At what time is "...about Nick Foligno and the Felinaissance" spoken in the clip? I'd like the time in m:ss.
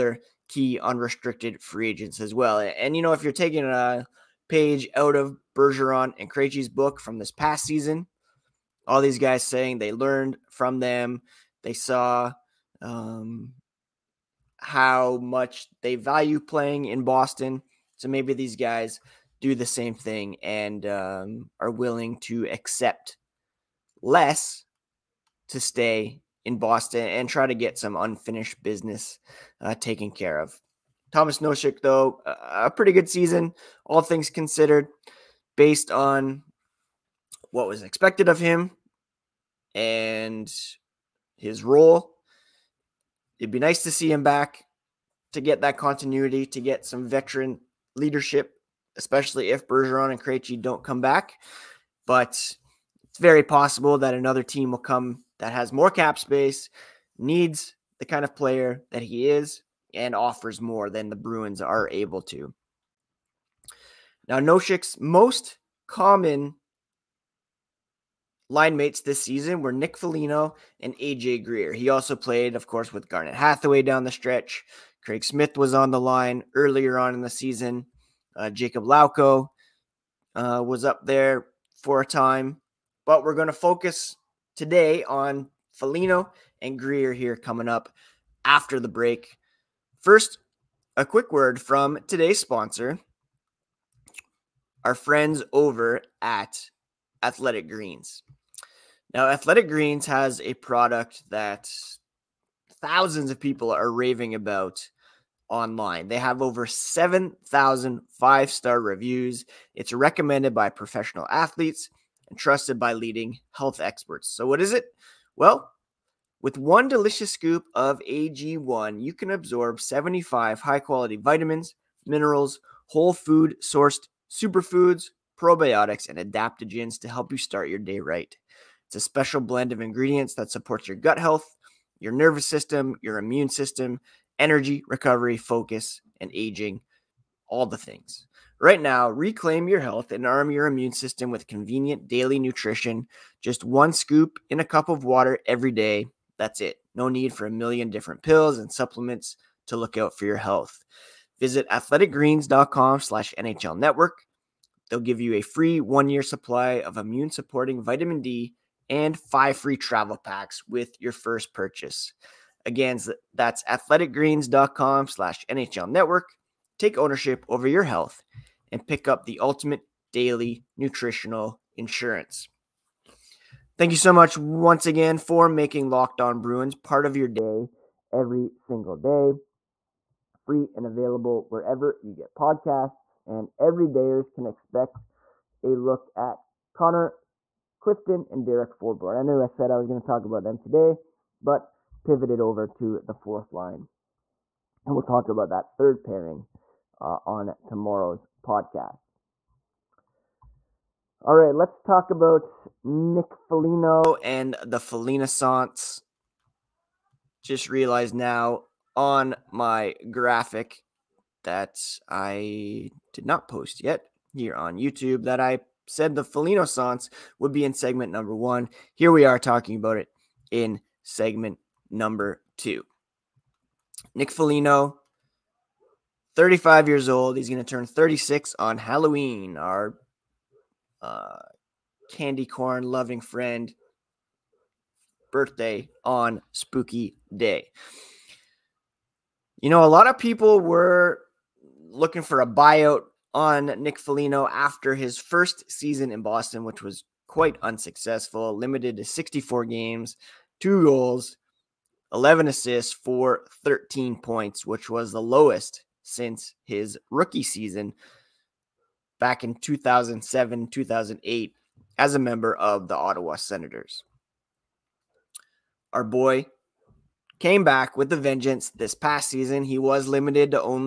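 3:22.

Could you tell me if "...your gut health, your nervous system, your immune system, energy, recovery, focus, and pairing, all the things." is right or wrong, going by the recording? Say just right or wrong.
wrong.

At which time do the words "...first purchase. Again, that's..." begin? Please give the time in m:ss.
2:41.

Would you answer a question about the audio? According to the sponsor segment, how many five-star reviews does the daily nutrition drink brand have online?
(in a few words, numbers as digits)
7,000.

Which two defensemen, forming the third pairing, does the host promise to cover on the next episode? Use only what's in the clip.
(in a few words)
Connor Clifton and Derek Forbort.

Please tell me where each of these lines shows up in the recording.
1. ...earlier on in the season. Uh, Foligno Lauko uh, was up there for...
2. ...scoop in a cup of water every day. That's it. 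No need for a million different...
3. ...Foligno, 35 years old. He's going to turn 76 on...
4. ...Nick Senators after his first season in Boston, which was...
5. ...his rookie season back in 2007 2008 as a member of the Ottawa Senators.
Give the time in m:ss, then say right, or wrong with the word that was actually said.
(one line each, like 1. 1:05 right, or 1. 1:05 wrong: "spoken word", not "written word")
1. 1:16 wrong: "Jacob", not "Foligno"
2. 2:23 right
3. 3:44 wrong: "36", not "76"
4. 4:03 wrong: "Foligno", not "Senators"
5. 4:16 right.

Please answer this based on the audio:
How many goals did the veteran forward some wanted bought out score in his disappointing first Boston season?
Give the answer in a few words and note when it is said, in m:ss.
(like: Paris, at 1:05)
2, at 4:10.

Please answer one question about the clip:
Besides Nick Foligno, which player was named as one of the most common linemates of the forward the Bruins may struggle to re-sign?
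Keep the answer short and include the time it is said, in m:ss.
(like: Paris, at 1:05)
AJ Greer, at 1:10.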